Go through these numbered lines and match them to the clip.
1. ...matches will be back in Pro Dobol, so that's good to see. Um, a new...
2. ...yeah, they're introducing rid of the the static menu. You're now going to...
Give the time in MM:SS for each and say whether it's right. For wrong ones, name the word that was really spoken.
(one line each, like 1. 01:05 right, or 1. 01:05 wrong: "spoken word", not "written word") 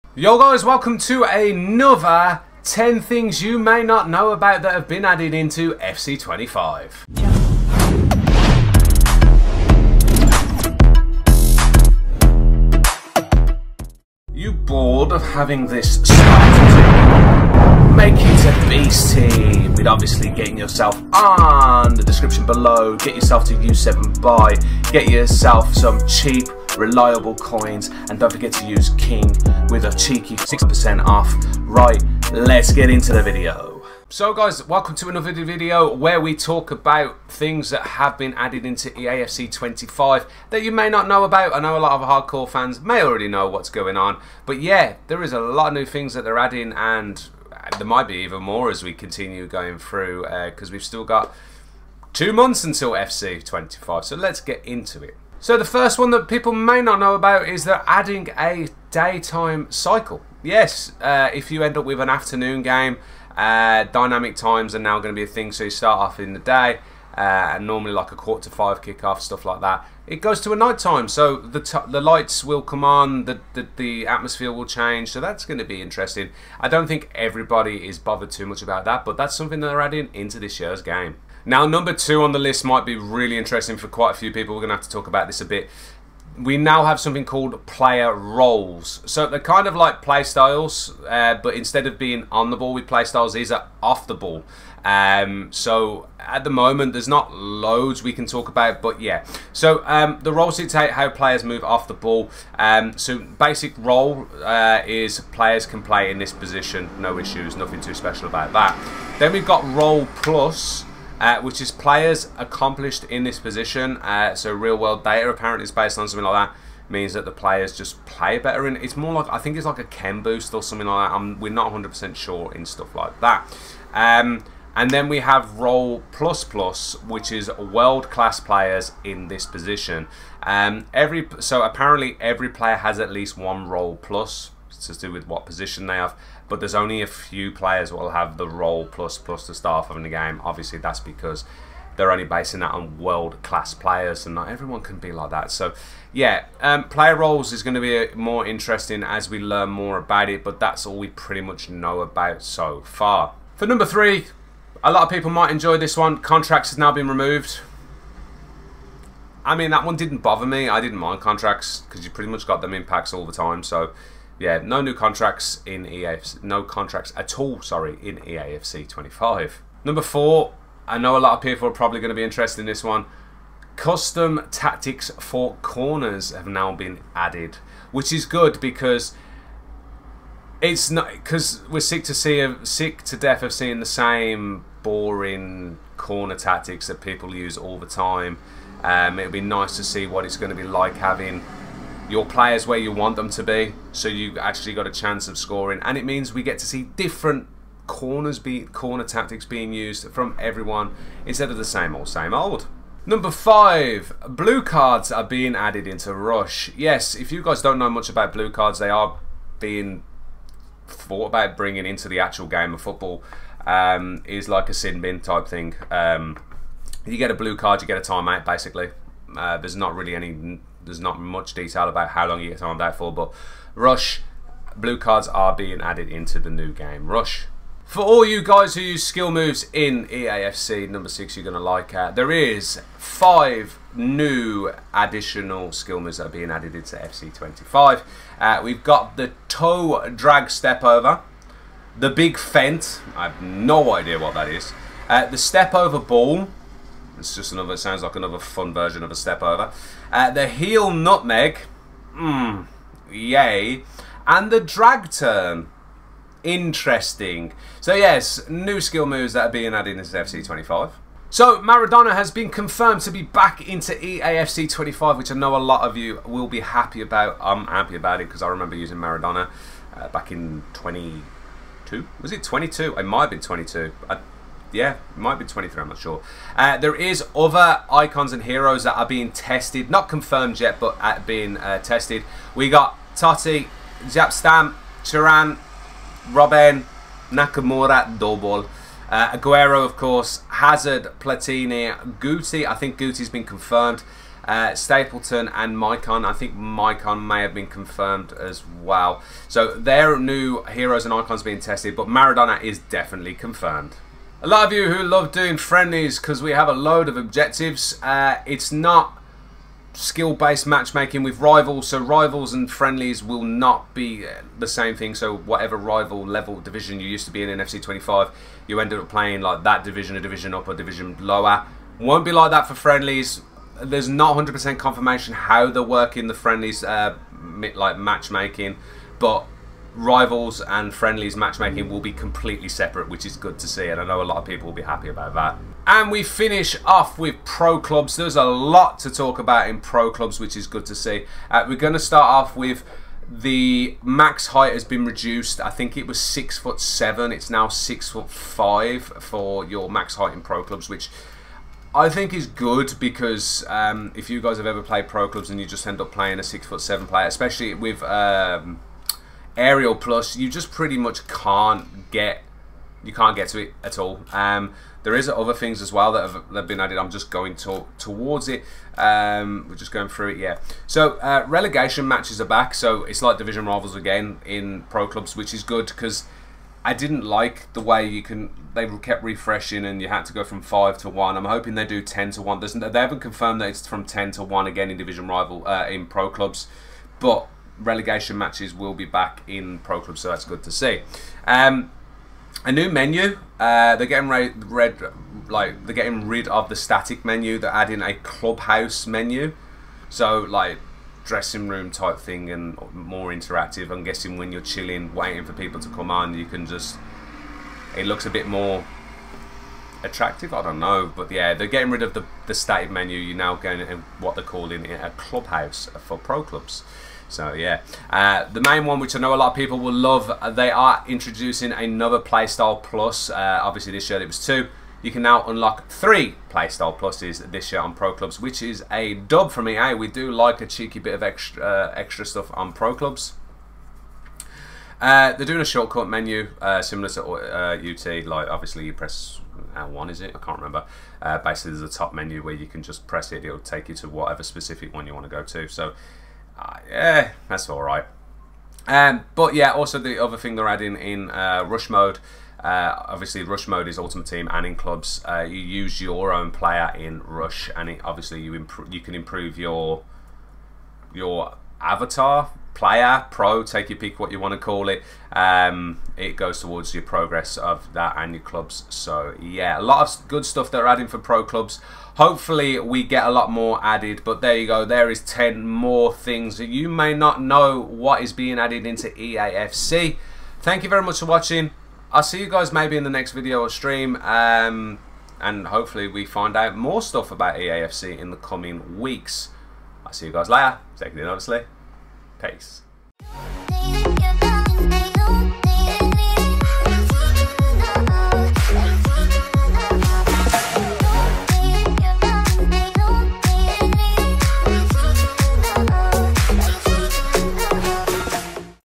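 1. 06:28 wrong: "Club", not "Dobol"
2. 06:51 wrong: "getting", not "introducing".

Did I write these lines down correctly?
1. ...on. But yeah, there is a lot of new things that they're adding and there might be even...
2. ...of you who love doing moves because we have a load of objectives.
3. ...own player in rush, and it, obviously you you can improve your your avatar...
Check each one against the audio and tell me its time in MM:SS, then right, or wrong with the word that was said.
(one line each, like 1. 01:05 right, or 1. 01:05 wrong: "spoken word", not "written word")
1. 00:43 right
2. 05:04 wrong: "friendlies", not "moves"
3. 07:36 right.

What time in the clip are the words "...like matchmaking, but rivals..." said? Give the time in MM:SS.
05:27.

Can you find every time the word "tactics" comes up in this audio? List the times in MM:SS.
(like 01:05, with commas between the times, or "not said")
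02:54, 03:06, 03:19.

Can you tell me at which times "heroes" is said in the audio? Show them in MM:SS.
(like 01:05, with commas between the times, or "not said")
04:38, 05:00.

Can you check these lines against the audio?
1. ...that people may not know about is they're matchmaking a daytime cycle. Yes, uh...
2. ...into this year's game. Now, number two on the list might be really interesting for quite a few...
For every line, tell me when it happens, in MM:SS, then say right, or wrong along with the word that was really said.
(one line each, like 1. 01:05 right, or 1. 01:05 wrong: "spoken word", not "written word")
1. 00:56 wrong: "adding", not "matchmaking"
2. 01:20 right.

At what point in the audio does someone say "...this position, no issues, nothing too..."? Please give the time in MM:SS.
01:46.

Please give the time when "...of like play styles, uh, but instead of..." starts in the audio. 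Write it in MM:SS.
01:29.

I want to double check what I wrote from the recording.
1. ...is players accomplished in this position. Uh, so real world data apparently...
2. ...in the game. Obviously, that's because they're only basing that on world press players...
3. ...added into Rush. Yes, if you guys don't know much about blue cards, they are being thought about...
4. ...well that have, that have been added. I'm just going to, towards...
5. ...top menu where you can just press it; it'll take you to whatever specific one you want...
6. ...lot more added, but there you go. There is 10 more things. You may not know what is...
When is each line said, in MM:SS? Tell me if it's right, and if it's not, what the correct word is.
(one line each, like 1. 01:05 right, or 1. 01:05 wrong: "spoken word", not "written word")
1. 01:51 right
2. 02:19 wrong: "class", not "press"
3. 03:25 right
4. 06:05 right
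5. 07:21 right
6. 07:53 right.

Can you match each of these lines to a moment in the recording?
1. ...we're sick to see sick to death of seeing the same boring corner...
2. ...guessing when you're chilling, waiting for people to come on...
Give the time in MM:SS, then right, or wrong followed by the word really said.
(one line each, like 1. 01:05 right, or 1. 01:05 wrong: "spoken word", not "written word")
1. 03:01 right
2. 06:44 right.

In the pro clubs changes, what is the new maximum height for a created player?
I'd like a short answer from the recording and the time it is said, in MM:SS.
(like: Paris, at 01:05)
6 foot 5, at 05:47.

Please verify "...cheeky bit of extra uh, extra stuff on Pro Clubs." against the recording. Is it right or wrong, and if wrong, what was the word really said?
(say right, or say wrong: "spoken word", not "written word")
right.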